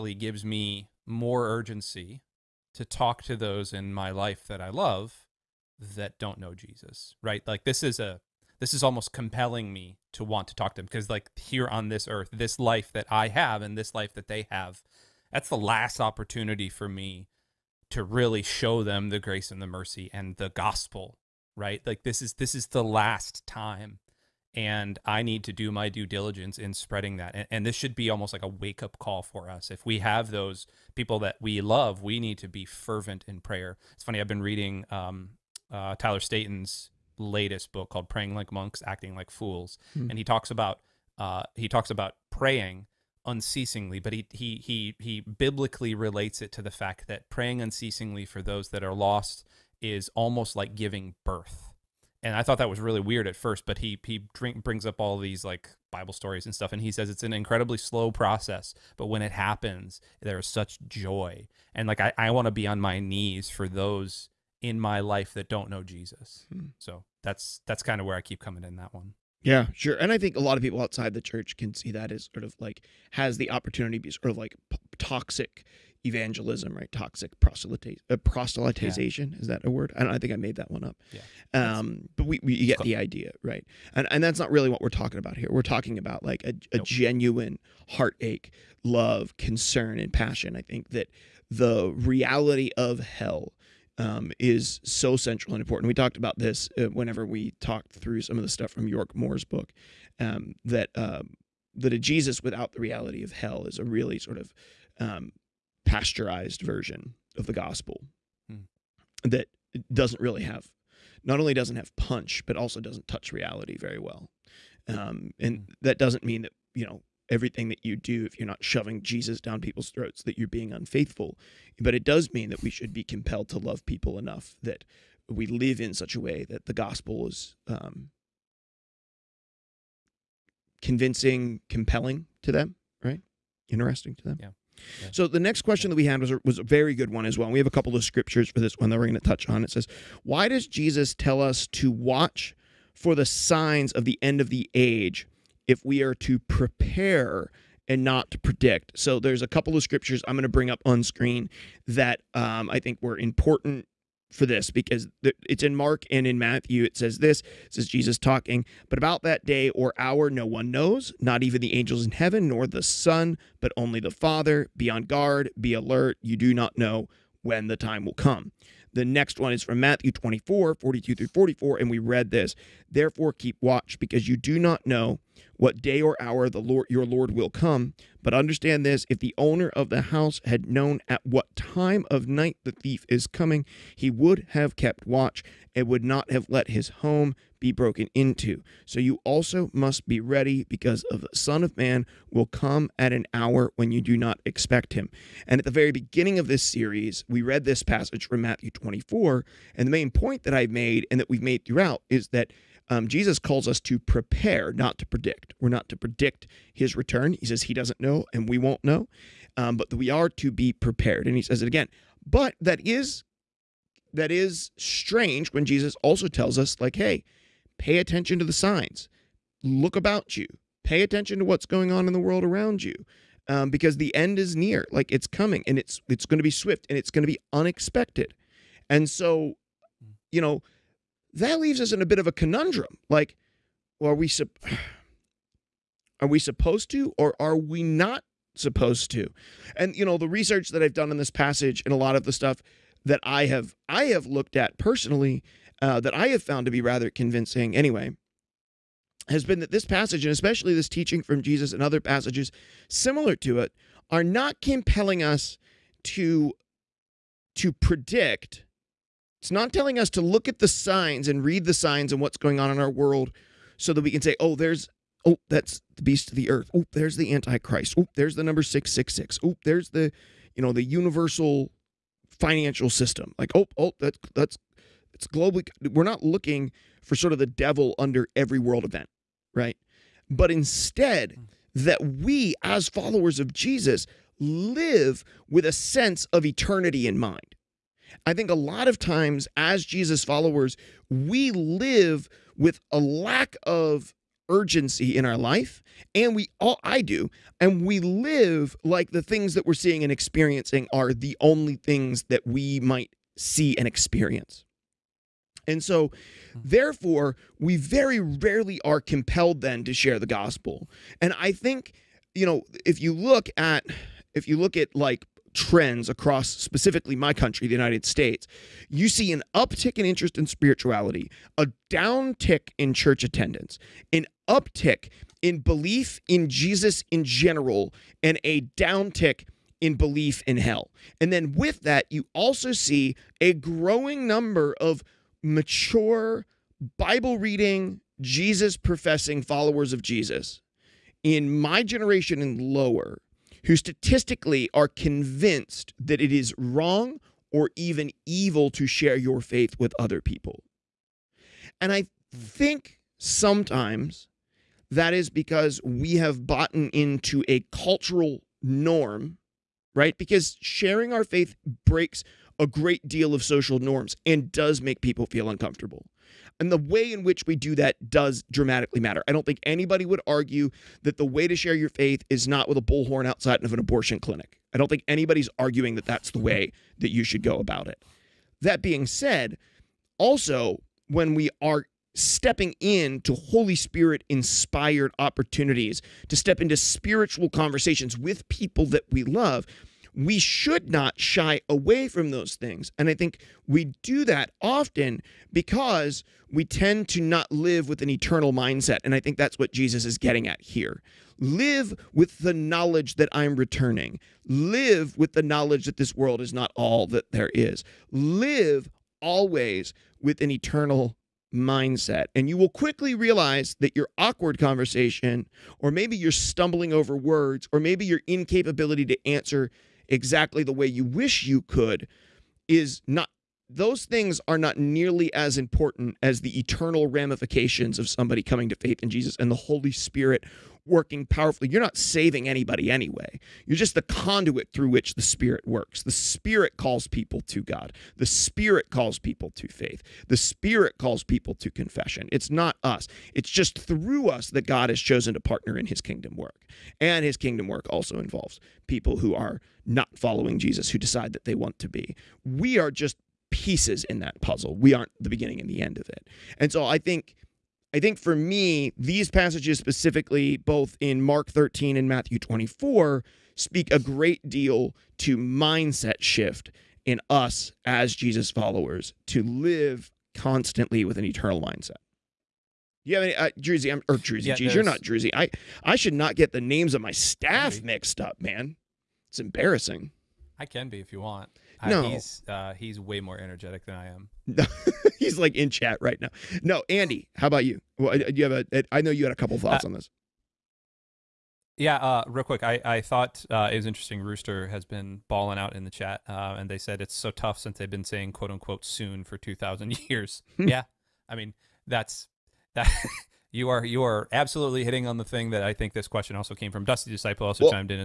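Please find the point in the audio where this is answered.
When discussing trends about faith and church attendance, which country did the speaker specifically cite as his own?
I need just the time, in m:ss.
5:17.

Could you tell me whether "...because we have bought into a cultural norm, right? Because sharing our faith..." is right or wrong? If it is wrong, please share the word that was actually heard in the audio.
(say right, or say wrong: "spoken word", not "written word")
right.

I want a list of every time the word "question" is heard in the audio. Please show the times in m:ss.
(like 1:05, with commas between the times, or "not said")
2:15, 8:26.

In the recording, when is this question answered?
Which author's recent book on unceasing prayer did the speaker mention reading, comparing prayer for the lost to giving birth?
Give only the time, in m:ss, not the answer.
0:35.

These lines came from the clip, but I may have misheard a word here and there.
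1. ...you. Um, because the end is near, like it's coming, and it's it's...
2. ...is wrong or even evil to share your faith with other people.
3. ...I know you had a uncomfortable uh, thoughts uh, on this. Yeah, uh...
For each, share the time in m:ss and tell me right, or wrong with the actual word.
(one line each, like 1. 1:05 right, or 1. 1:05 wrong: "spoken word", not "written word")
1. 3:42 right
2. 5:46 right
3. 8:08 wrong: "couple", not "uncomfortable".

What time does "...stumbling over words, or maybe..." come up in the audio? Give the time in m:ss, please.
6:56.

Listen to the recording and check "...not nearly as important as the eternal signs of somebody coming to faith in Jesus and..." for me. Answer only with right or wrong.
wrong.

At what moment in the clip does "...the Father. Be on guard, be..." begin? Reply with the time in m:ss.
2:43.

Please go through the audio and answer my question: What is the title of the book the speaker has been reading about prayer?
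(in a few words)
Praying Like Monks, Acting Like Fools.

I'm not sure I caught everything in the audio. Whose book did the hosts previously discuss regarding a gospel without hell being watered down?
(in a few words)
York Moore.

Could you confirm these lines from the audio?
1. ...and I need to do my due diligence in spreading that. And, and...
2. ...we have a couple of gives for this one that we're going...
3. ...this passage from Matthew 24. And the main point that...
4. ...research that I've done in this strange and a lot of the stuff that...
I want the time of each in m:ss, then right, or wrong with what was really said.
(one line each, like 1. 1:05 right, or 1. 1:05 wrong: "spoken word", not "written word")
1. 0:24 right
2. 2:17 wrong: "scriptures", not "gives"
3. 3:17 right
4. 4:00 wrong: "passage", not "strange".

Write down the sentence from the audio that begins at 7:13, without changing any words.
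You're just the conduit through which the Spirit works.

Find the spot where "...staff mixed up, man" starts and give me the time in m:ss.
7:57.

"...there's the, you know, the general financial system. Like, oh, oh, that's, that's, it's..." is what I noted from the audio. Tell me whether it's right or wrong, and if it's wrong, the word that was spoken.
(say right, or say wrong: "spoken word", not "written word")
wrong: "universal", not "general".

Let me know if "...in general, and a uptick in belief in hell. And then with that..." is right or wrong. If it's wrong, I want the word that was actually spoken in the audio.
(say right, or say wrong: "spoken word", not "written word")
wrong: "downtick", not "uptick".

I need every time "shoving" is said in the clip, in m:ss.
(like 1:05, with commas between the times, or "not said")
1:58.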